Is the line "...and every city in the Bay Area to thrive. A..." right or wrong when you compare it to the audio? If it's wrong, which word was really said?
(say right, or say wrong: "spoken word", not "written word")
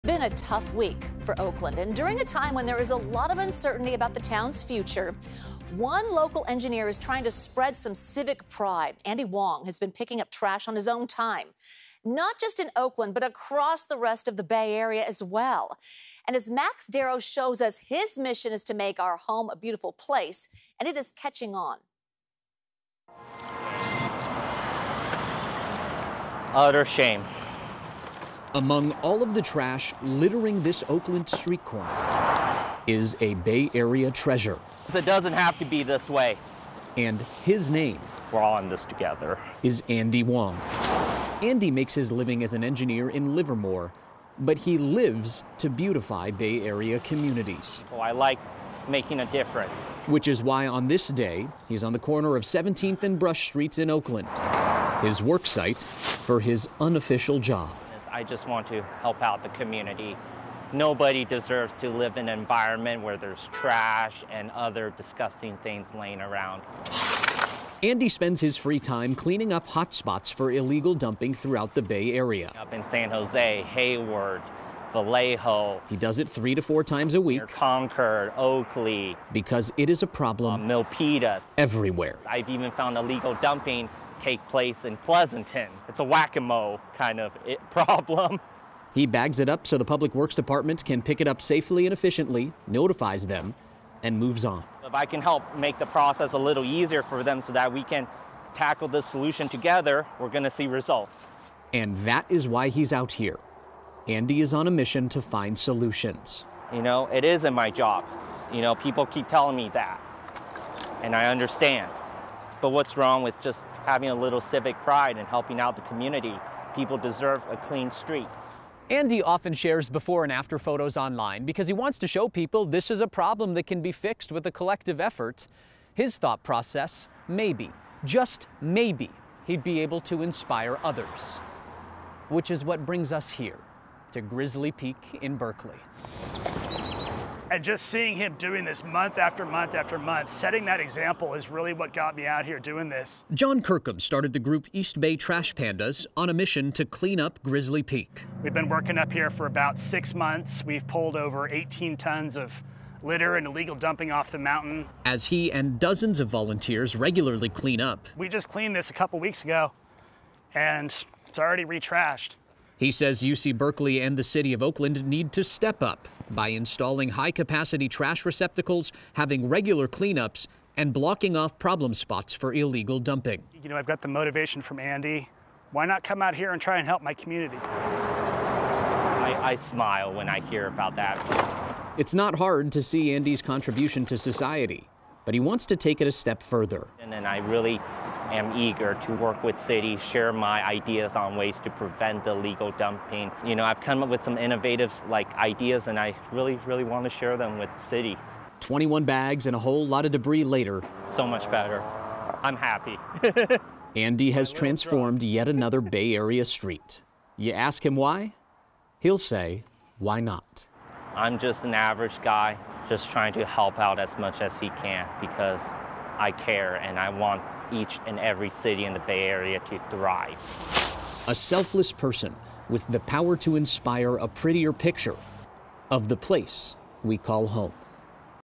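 right.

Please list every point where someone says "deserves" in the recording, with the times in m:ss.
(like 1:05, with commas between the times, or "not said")
1:01, 1:56.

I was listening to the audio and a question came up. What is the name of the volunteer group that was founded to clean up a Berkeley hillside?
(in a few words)
East Bay Trash Pandas.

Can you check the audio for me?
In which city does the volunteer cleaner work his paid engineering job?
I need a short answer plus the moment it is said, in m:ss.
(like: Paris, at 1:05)
Livermore, at 0:43.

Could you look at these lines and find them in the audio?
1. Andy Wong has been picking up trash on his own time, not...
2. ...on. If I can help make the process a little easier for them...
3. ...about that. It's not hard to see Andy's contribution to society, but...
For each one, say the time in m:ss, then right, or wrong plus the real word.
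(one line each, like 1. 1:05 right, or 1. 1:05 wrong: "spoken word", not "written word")
1. 0:09 right
2. 1:34 right
3. 3:00 right.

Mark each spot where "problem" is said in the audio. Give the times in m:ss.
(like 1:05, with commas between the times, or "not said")
1:20, 1:27, 2:03, 2:51.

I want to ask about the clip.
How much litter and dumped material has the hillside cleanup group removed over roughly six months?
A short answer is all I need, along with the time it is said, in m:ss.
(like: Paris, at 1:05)
over 18 tons, at 2:31.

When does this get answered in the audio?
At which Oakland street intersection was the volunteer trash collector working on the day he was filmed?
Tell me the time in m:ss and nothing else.
0:52.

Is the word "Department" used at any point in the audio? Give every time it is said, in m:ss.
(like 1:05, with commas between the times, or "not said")
1:30.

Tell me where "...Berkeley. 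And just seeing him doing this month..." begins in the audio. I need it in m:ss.
2:15.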